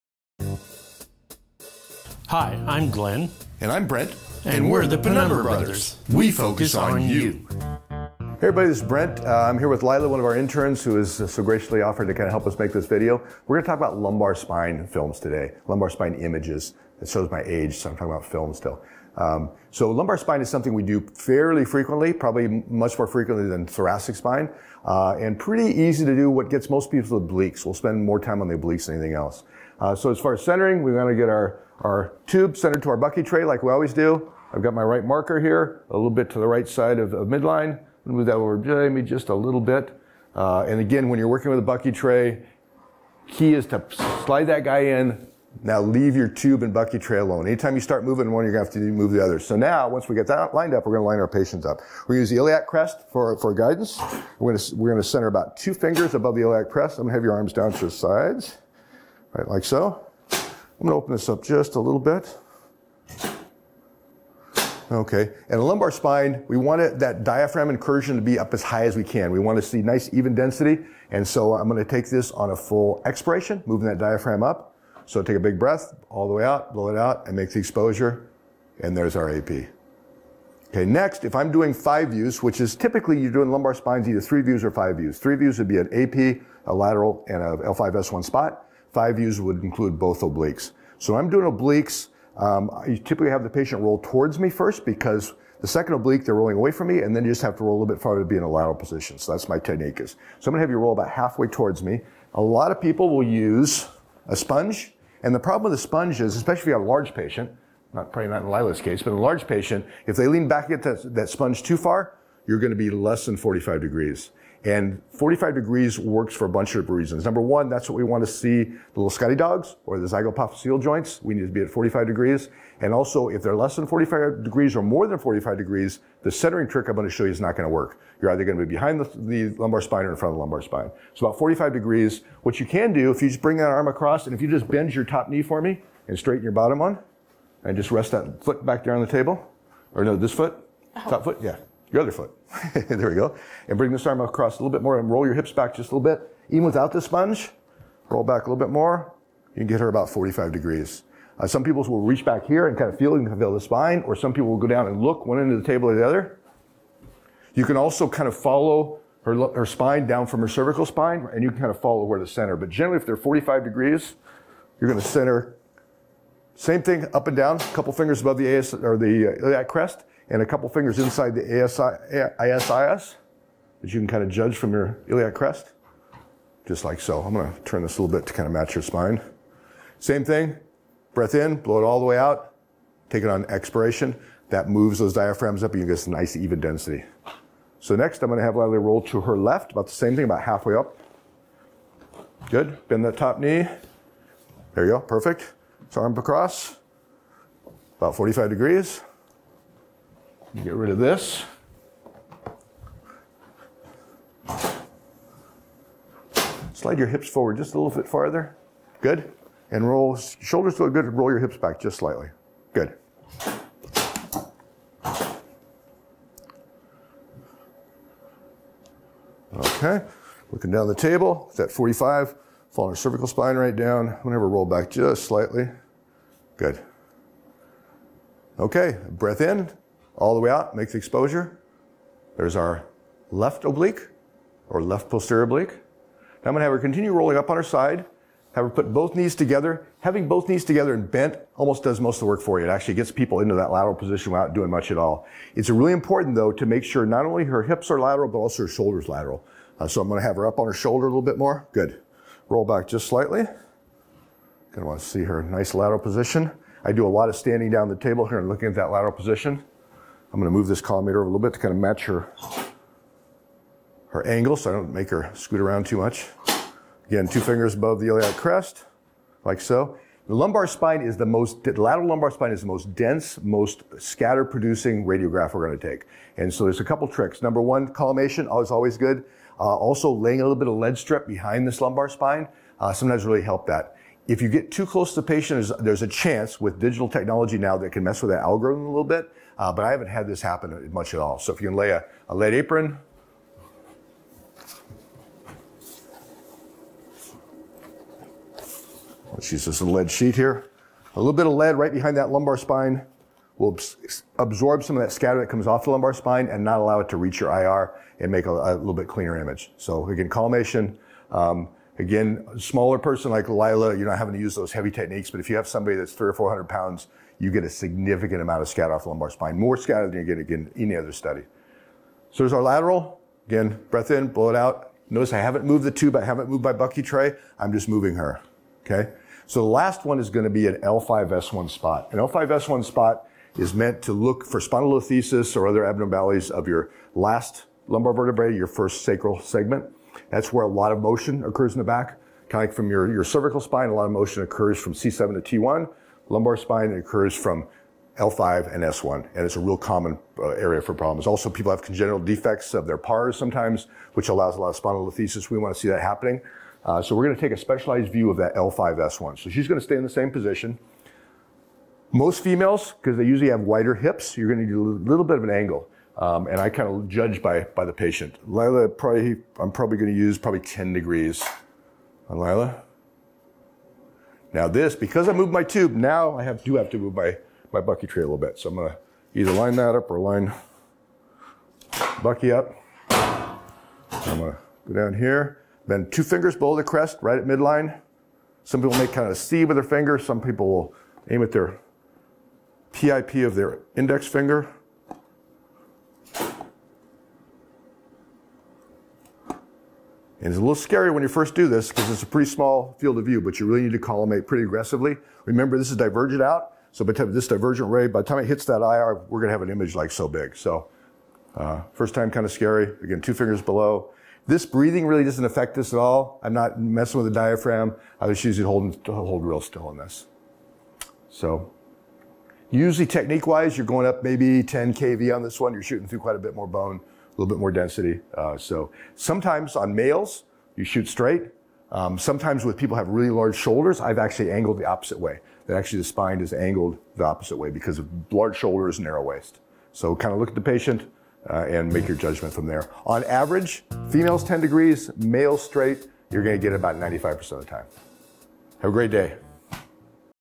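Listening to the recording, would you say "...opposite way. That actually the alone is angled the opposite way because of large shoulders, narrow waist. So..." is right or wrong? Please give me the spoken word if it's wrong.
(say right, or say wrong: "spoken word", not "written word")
wrong: "spine", not "alone".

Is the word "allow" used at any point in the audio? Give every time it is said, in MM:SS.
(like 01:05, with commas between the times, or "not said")
05:06, 05:54.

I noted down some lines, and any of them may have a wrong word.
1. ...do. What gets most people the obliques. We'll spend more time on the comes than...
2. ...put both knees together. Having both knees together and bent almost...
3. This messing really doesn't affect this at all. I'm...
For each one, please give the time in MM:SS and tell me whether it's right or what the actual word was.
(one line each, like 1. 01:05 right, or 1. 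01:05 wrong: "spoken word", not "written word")
1. 00:26 wrong: "obliques", not "comes"
2. 03:58 right
3. 06:54 wrong: "breathing", not "messing".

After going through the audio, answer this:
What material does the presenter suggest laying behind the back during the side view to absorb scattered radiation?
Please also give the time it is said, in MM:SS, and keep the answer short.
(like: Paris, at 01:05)
lead strip, at 04:40.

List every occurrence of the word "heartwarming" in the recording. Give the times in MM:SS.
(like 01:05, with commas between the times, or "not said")
not said.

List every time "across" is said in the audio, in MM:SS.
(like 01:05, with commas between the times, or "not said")
02:13, 02:24, 03:16.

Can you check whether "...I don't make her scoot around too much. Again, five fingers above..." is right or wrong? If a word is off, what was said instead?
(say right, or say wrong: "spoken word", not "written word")
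wrong: "two", not "five".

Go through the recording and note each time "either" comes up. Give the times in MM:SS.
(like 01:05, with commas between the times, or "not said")
01:24, 02:08, 06:19.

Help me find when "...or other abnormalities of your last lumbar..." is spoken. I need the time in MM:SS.
05:35.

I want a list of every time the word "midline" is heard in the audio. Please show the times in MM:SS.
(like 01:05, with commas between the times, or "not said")
00:37, 06:27.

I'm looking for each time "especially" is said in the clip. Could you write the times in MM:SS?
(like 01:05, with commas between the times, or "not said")
01:46.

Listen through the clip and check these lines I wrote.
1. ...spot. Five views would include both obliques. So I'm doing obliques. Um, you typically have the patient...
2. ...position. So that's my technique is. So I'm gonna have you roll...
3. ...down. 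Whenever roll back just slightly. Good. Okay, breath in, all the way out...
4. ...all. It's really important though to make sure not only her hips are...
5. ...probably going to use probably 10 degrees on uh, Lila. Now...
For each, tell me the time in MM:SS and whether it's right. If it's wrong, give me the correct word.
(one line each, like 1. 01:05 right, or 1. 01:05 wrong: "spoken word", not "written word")
1. 01:28 right
2. 01:38 right
3. 03:43 right
4. 04:04 right
5. 06:09 right.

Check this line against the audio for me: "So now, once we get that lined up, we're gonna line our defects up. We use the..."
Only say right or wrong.
wrong.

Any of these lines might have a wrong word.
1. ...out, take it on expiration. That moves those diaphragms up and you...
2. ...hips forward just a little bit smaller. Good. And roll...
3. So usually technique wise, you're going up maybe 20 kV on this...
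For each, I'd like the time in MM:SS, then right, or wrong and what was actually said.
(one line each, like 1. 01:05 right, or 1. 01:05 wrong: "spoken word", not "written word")
1. 03:02 right
2. 03:27 wrong: "farther", not "smaller"
3. 07:01 wrong: "10", not "20".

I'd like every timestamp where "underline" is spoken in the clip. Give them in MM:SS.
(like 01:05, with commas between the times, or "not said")
not said.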